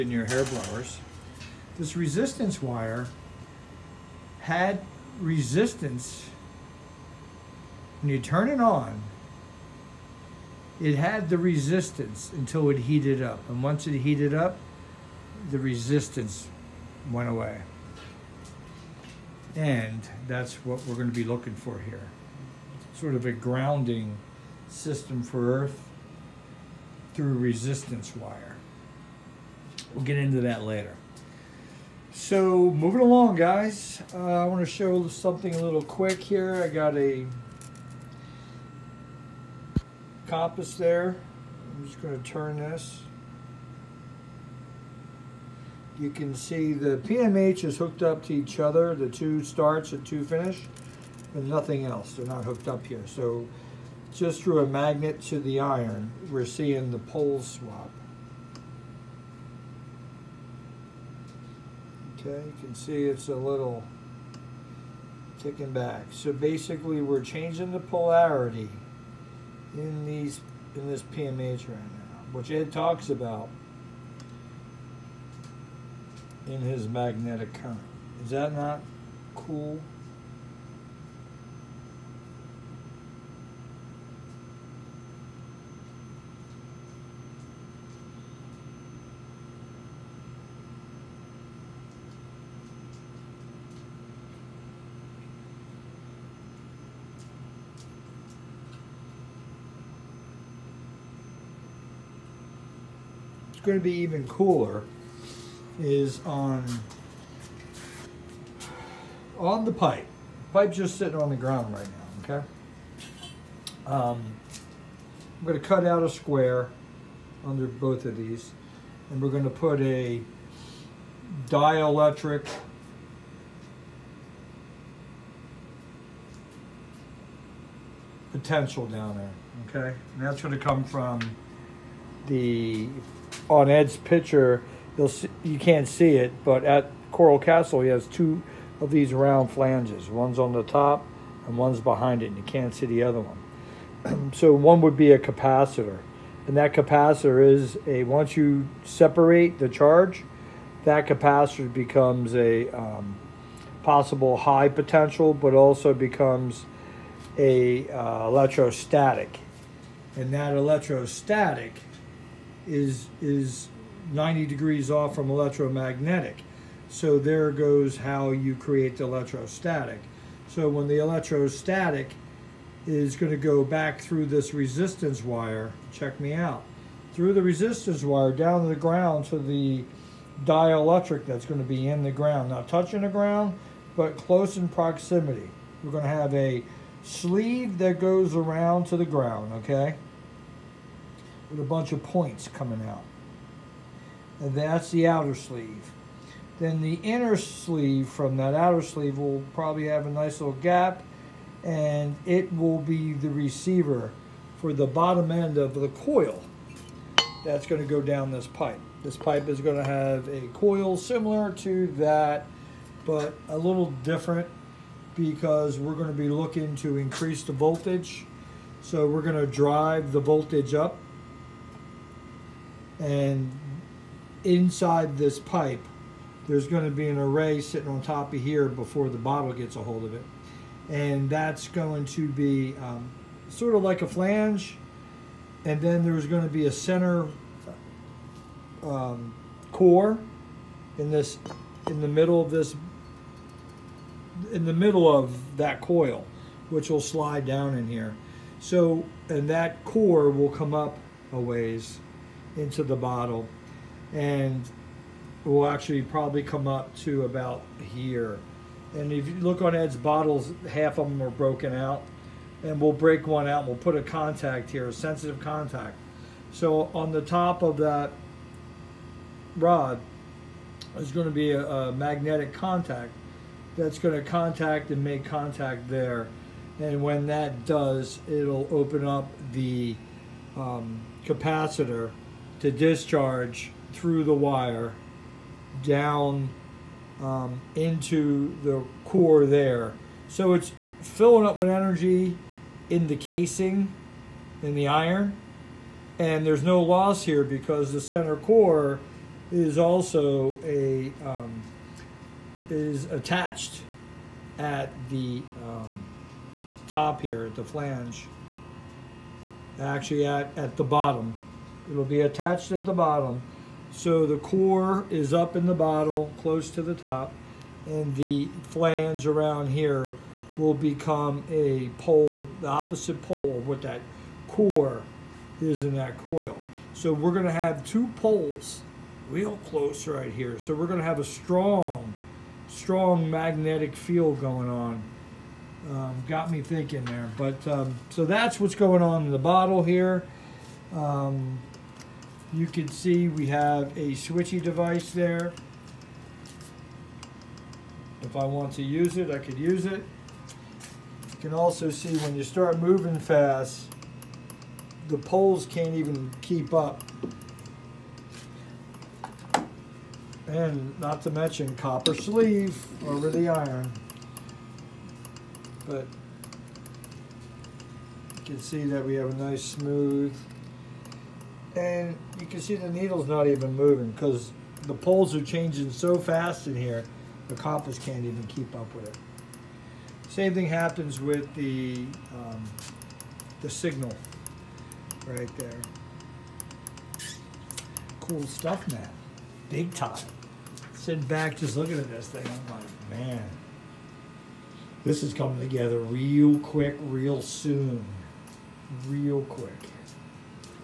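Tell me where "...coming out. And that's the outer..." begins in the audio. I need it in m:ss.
3:12.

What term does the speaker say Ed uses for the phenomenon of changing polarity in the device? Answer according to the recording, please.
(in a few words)
Magnetic current.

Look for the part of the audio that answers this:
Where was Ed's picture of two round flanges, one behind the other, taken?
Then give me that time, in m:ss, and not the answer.
2:17.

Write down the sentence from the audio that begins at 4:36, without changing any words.
And when that does, it'll open up the um, capacitor to discharge through the wire down um, into the core there.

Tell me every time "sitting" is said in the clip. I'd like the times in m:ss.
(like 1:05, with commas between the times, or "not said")
1:50, 3:47, 6:30.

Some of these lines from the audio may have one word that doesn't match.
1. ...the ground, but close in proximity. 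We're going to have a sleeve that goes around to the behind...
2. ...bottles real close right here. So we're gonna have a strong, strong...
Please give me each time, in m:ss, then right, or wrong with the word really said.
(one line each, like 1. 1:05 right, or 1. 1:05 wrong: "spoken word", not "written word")
1. 3:03 wrong: "ground", not "behind"
2. 5:28 wrong: "poles", not "bottles".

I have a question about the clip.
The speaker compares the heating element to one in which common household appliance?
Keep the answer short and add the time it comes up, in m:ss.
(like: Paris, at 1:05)
Hair blowers, at 0:00.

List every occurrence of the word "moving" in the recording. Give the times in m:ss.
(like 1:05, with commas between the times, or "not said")
0:32, 5:52, 6:13.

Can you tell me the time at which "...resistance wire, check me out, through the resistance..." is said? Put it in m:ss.
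2:54.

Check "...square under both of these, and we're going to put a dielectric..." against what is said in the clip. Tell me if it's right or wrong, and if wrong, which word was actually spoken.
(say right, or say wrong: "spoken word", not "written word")
right.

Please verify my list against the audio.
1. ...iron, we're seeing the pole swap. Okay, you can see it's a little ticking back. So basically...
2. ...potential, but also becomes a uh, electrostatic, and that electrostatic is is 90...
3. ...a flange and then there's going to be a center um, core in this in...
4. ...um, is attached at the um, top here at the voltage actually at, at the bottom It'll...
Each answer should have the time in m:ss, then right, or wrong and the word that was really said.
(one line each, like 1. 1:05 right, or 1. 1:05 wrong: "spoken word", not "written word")
1. 0:55 right
2. 2:34 right
3. 3:54 right
4. 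5:01 wrong: "flange", not "voltage".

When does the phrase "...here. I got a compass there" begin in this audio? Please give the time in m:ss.
0:36.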